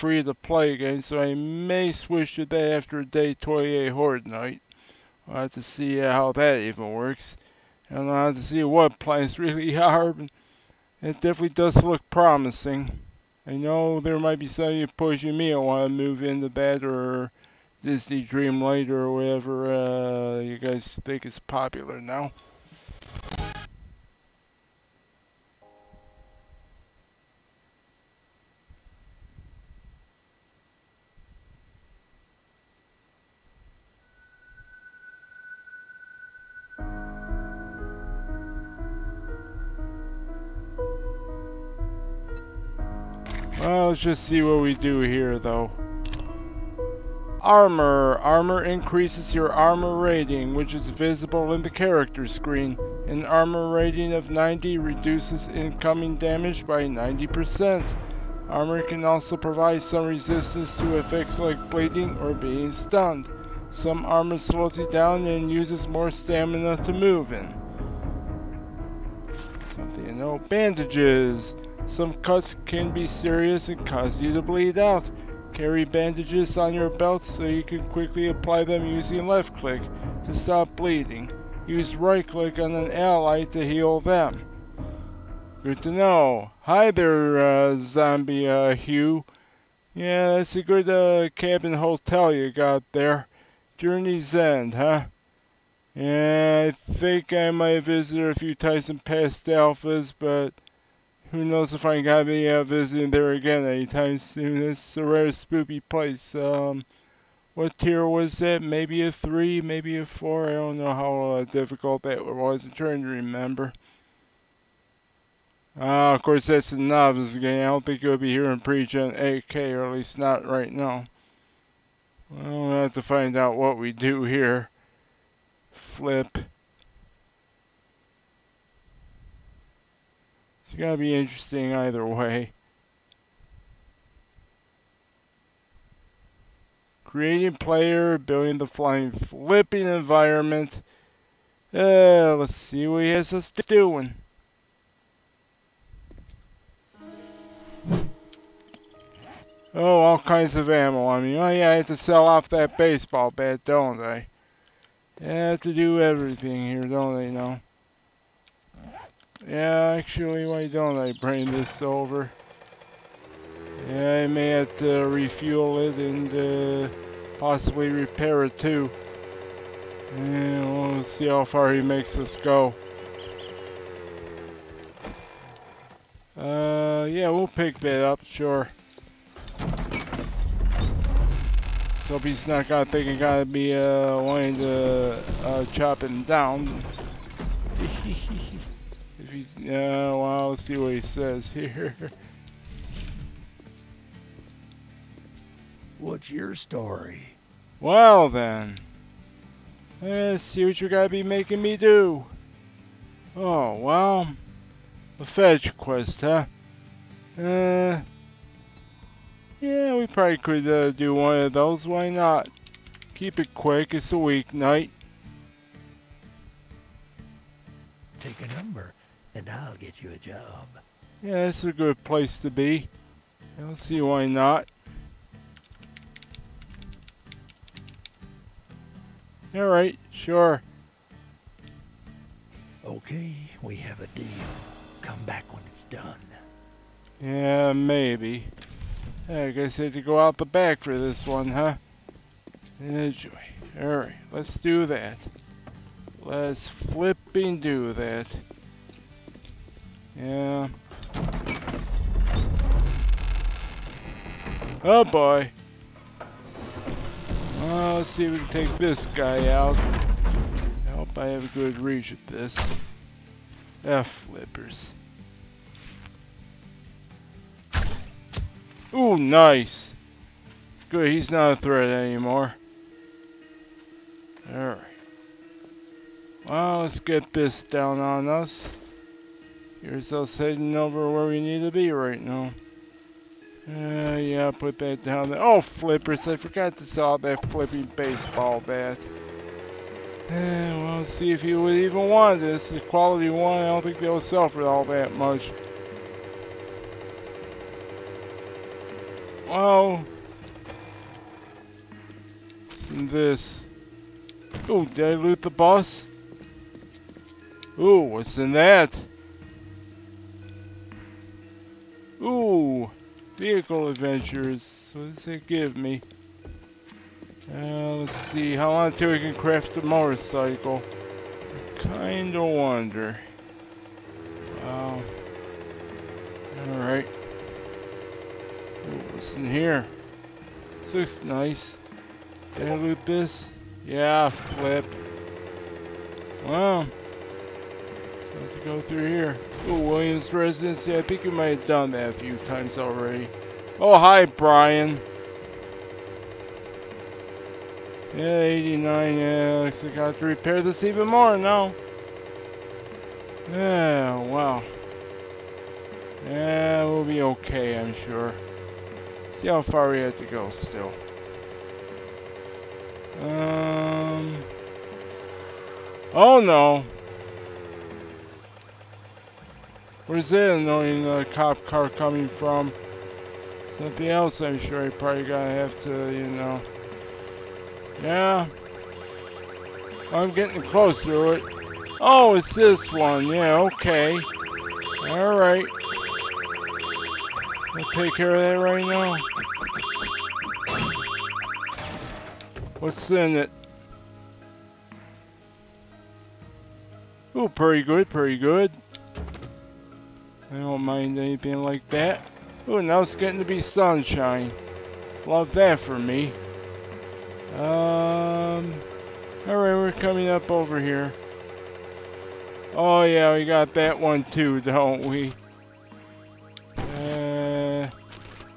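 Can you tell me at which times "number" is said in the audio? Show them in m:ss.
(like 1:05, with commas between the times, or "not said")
3:38.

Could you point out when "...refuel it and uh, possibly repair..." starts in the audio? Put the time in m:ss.
2:45.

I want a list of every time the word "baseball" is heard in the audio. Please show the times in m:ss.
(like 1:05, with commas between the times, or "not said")
2:32, 4:47.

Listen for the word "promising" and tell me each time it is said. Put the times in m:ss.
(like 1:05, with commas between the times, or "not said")
0:12.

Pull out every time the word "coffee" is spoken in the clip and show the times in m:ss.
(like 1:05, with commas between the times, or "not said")
not said.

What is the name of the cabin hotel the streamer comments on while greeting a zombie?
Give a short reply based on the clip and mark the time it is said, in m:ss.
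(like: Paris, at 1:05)
Journey's End, at 1:33.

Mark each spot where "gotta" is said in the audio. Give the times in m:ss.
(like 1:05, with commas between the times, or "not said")
3:03, 6:15.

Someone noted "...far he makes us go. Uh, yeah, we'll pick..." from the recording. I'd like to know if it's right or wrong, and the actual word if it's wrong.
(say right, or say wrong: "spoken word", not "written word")
right.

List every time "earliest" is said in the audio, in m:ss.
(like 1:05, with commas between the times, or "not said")
not said.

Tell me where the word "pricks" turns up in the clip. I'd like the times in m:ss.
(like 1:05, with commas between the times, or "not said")
not said.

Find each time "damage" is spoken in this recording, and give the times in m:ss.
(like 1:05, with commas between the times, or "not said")
0:56.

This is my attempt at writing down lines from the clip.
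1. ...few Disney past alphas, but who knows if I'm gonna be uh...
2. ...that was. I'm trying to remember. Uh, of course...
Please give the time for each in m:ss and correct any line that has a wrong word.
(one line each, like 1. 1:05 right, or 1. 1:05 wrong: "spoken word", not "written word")
1. 1:38 wrong: "Tyson", not "Disney"
2. 1:52 right.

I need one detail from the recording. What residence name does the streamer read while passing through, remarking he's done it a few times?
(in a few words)
Williams Residency.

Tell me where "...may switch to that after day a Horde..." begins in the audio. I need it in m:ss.
0:01.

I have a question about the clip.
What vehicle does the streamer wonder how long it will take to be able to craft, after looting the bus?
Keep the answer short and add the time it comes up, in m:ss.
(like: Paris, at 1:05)
motorcycle, at 5:19.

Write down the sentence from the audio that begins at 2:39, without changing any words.
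Yeah, actually, why don't I bring this over?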